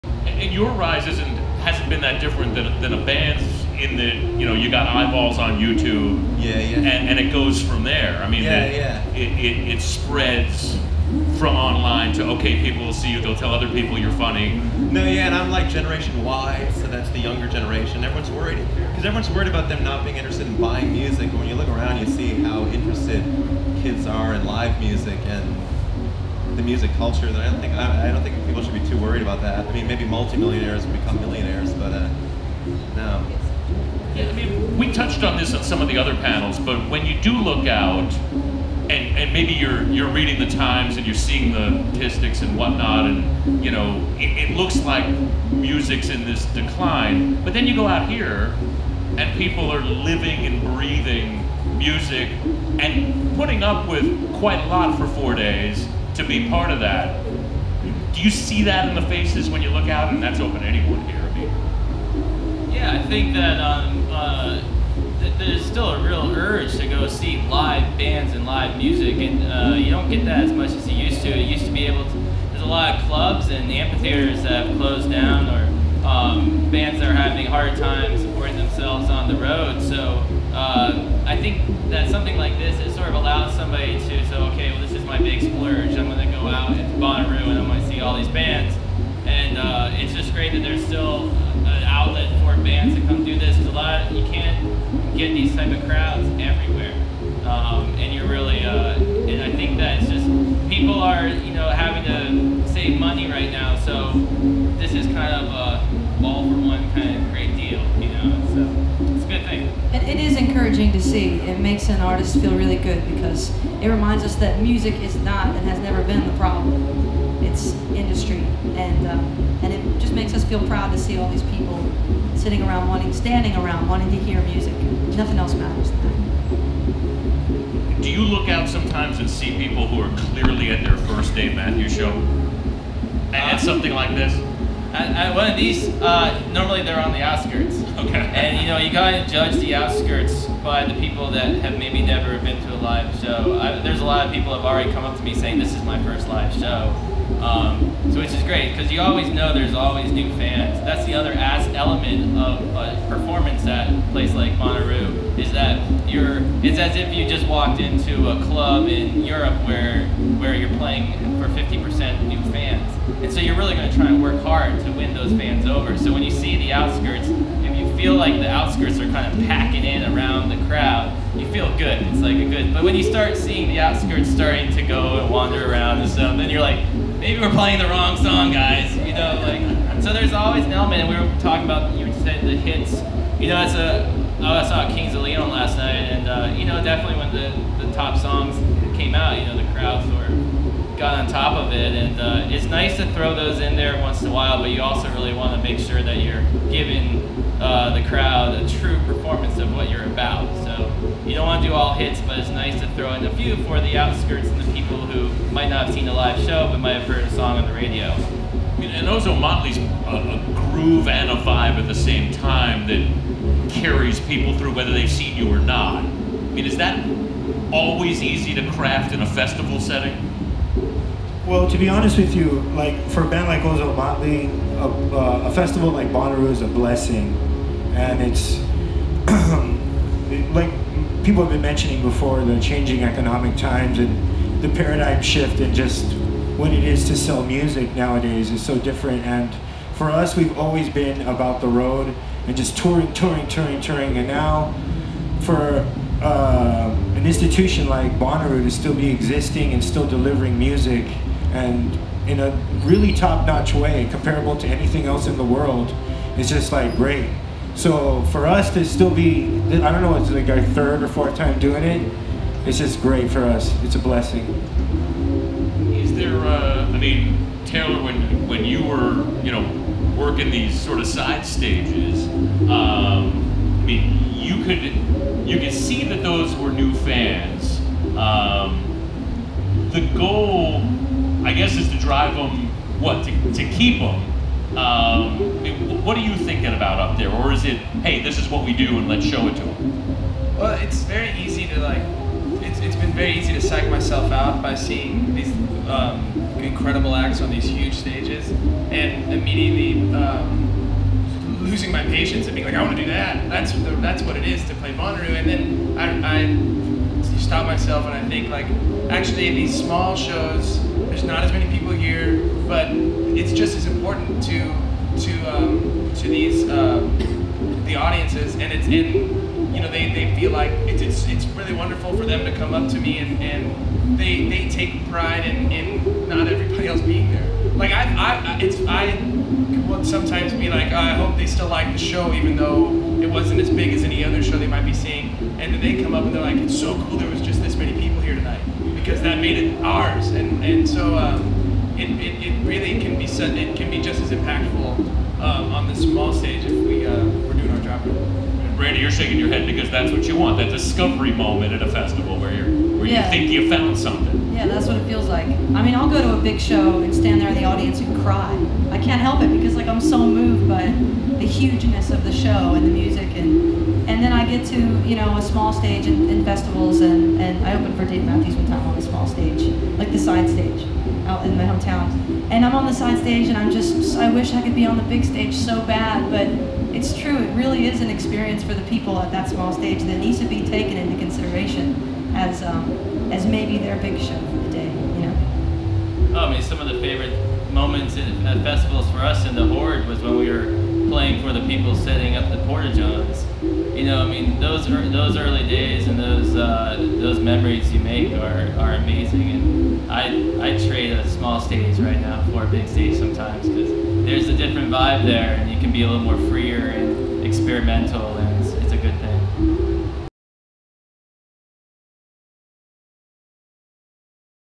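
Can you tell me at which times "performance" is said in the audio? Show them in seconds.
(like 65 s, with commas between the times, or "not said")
153 s, 199 s.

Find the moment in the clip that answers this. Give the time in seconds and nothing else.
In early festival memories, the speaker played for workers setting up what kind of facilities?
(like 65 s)
392 s.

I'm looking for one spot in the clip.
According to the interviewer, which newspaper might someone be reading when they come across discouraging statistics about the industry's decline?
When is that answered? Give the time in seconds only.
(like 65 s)
40 s.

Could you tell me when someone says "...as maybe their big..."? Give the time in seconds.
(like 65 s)
383 s.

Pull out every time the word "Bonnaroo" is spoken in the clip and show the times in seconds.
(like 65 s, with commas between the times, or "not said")
86 s, 154 s, 226 s, 248 s, 304 s.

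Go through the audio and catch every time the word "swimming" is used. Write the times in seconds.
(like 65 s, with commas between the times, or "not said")
not said.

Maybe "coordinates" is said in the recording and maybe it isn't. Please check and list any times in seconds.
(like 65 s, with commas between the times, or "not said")
not said.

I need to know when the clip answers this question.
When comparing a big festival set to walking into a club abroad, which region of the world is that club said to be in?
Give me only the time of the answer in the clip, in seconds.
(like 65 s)
159 s.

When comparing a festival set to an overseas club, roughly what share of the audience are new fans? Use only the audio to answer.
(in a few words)
50%.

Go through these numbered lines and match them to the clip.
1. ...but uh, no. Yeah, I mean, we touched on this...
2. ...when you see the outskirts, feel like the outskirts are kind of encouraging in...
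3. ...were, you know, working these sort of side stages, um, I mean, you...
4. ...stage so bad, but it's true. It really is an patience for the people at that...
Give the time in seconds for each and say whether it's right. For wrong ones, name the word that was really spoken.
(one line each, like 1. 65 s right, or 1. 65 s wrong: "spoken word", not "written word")
1. 31 s right
2. 166 s wrong: "packing", not "encouraging"
3. 268 s right
4. 375 s wrong: "experience", not "patience".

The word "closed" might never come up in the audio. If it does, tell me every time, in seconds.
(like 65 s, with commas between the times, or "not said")
74 s.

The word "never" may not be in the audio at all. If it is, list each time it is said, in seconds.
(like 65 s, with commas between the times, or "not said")
115 s, 142 s.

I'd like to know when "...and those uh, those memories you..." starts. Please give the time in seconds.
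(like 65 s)
396 s.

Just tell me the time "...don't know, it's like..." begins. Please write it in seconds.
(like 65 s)
259 s.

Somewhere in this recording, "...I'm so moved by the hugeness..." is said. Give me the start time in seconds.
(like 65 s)
359 s.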